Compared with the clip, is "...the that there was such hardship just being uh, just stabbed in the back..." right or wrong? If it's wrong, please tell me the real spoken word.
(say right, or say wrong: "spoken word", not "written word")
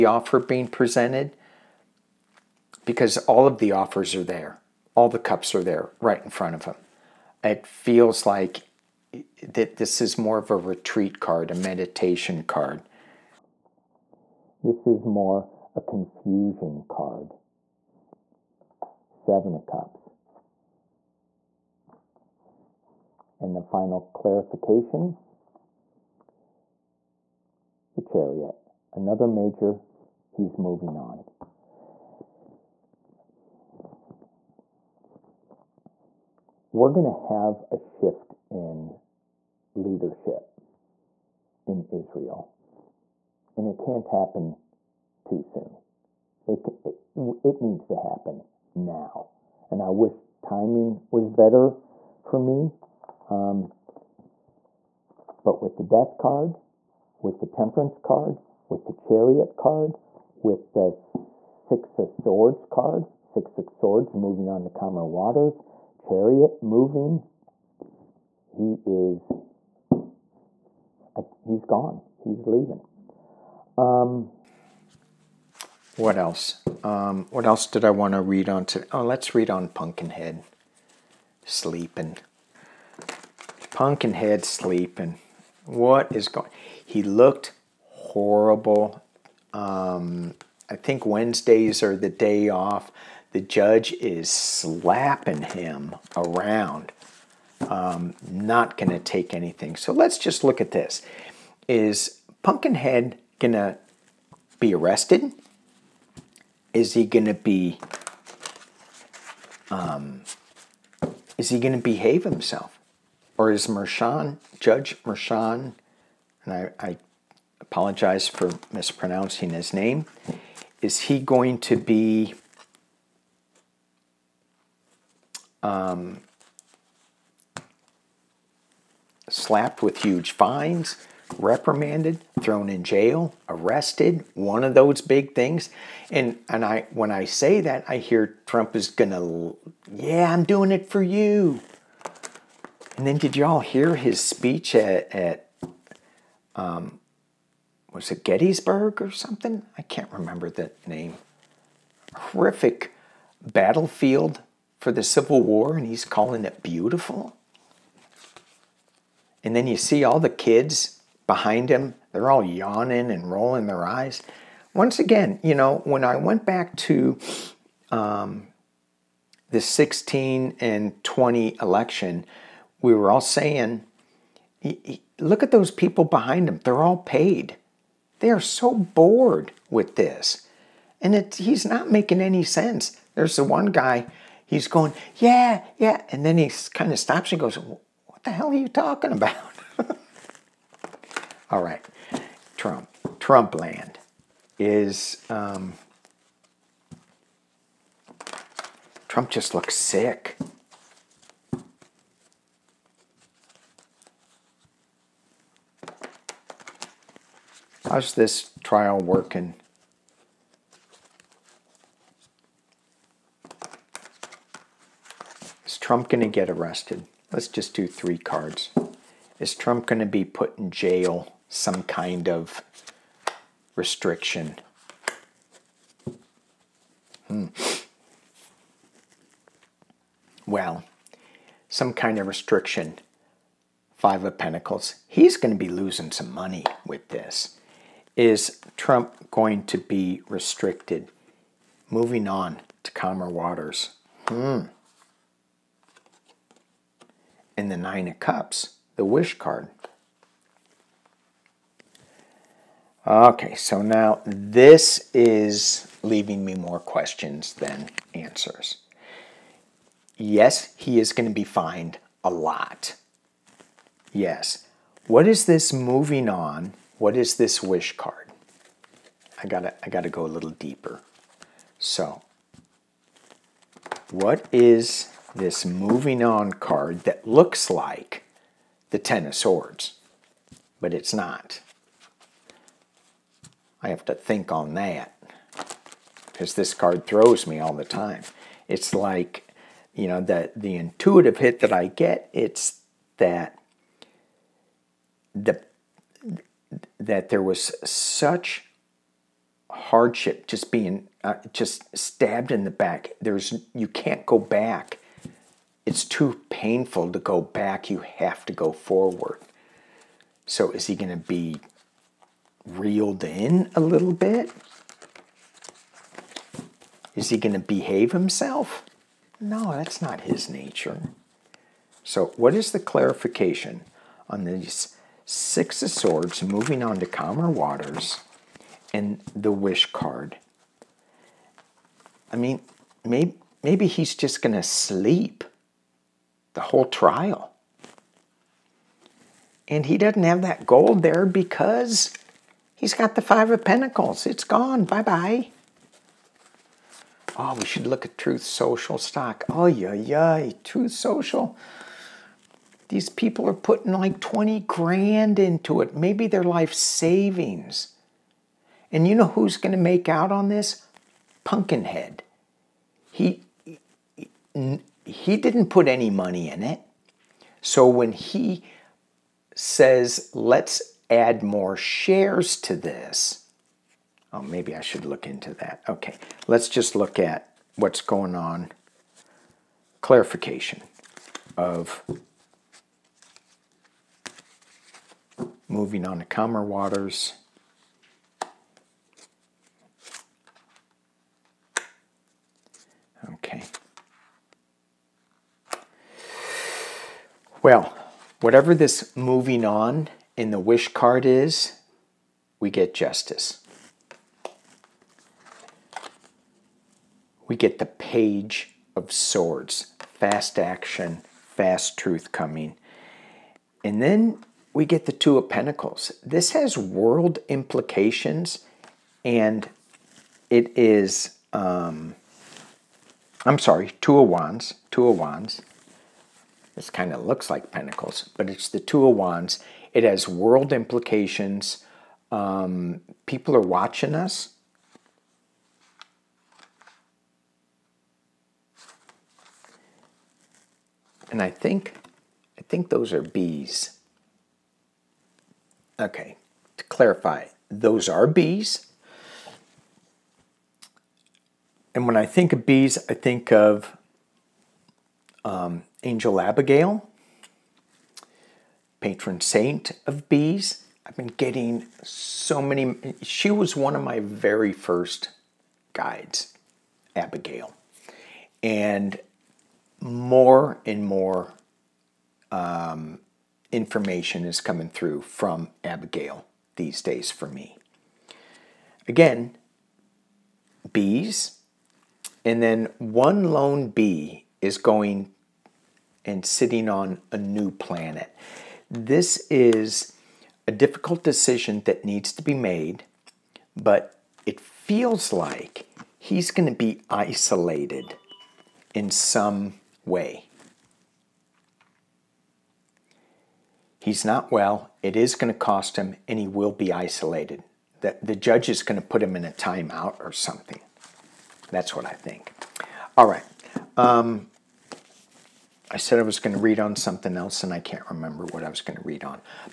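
right.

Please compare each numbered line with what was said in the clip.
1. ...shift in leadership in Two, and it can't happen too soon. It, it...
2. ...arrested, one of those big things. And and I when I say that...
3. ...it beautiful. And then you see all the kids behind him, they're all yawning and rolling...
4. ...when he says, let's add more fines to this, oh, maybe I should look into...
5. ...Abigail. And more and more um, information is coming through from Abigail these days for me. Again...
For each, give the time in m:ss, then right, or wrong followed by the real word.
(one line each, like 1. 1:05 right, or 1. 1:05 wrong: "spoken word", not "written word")
1. 0:37 wrong: "Israel", not "Two"
2. 2:13 right
3. 2:36 right
4. 6:07 wrong: "shares", not "fines"
5. 7:47 right.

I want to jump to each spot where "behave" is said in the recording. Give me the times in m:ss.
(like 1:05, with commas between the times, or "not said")
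1:51, 5:17.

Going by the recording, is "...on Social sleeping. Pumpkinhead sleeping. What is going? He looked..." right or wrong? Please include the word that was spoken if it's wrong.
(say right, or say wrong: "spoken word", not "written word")
wrong: "Pumpkinhead", not "Social".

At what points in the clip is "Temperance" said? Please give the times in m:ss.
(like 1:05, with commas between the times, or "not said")
0:57.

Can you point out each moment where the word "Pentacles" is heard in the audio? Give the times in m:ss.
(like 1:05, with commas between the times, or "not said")
3:54, 5:43, 6:55, 7:07.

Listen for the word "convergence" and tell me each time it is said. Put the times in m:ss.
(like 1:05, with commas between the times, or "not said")
not said.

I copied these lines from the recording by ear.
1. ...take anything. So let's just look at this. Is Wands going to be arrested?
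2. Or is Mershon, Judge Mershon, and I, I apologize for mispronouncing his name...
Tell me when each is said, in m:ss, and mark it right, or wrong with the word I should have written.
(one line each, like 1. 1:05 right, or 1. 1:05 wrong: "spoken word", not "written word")
1. 1:39 wrong: "Pumpkinhead", not "Wands"
2. 1:53 right.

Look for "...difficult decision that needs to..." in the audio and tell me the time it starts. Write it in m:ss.
8:10.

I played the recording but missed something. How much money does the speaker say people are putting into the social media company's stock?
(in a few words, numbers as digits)
20 grand.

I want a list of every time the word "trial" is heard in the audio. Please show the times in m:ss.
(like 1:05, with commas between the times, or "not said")
3:28, 5:36.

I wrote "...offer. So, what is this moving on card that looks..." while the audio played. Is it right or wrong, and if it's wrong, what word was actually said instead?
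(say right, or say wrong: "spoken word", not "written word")
wrong: "deeper", not "offer".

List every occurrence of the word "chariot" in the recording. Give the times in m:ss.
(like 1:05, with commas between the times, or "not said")
0:28, 0:58, 1:05.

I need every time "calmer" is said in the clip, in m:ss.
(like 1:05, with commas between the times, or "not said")
1:04, 4:02, 5:27, 6:26.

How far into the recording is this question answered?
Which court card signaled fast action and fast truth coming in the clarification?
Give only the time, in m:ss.
6:47.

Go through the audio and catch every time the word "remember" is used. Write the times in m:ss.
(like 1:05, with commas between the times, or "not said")
2:30, 8:38.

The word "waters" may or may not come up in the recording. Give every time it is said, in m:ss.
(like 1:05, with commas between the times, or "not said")
1:05, 4:03, 5:27, 6:26.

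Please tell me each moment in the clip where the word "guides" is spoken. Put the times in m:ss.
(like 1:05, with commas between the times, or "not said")
7:45.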